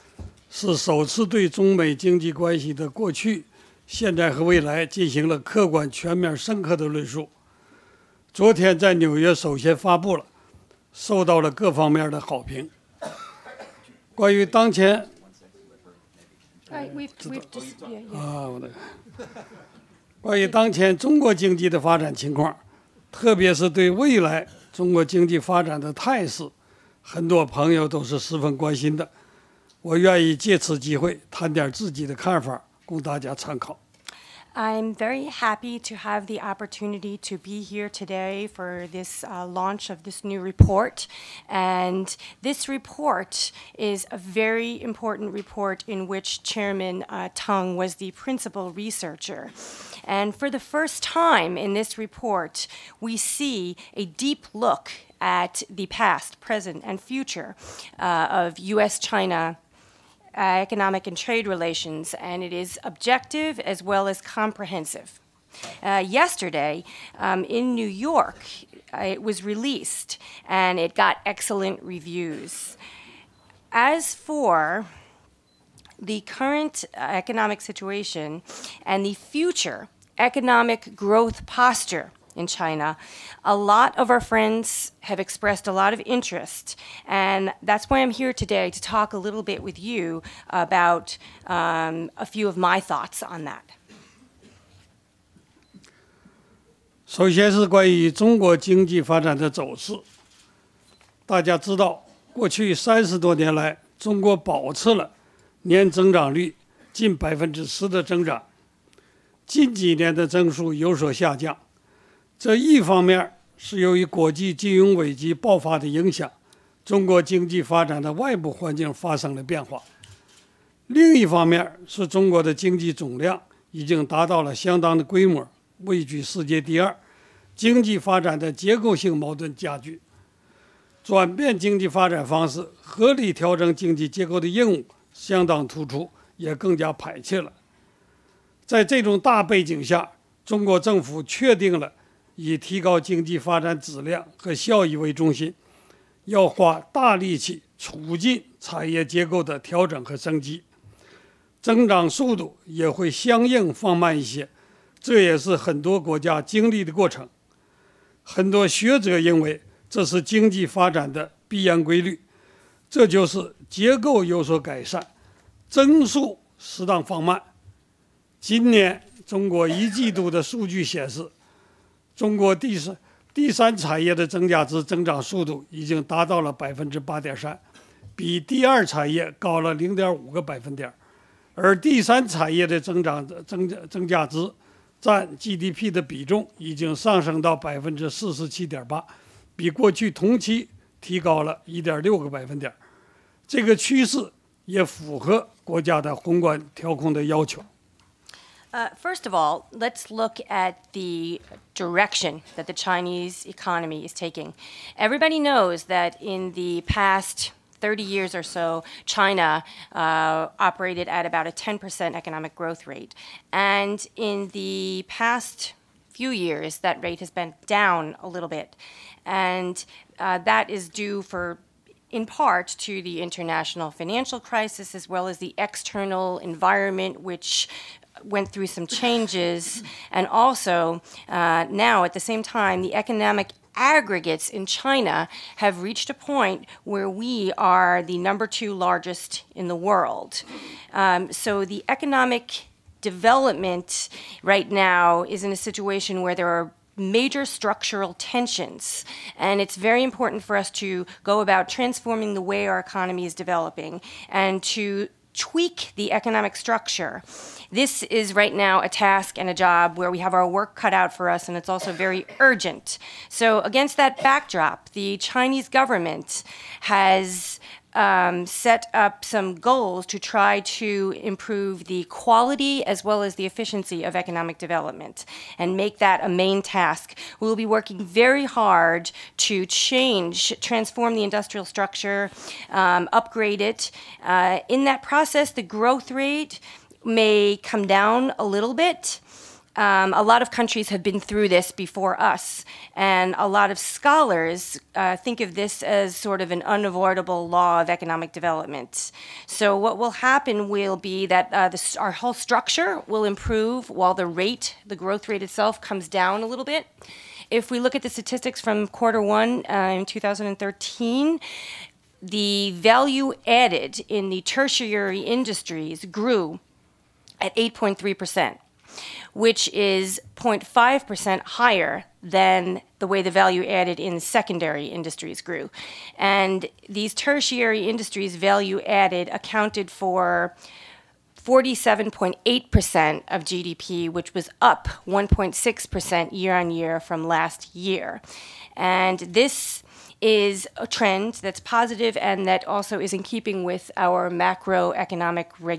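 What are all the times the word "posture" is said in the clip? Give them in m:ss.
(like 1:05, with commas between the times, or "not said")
1:21.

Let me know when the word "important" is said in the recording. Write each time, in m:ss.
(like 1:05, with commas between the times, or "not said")
0:44, 4:10.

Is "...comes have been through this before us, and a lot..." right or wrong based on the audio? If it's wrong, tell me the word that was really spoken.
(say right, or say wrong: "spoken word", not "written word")
wrong: "countries", not "comes".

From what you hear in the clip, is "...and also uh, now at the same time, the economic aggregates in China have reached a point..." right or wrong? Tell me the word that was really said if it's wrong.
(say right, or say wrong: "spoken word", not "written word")
right.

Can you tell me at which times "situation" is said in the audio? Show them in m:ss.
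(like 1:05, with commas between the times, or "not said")
1:17, 4:05.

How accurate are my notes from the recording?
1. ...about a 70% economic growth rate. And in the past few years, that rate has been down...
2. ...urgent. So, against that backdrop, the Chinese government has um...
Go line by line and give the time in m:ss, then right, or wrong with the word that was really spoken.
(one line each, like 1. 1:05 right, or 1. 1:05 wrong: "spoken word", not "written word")
1. 3:31 wrong: "10", not "70"
2. 4:22 right.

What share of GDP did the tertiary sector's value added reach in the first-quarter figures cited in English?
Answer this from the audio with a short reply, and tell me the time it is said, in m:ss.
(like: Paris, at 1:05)
47.8%, at 5:31.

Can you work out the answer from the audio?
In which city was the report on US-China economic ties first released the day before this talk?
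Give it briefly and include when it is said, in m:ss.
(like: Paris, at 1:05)
New York, at 1:07.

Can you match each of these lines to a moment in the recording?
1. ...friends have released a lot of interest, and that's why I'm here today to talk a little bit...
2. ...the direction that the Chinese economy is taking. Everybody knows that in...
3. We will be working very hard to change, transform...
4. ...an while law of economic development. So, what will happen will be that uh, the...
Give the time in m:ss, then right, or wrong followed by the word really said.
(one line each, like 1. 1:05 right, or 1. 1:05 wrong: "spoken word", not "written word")
1. 1:24 wrong: "expressed", not "released"
2. 3:20 right
3. 4:37 right
4. 4:56 wrong: "unavoidable", not "while".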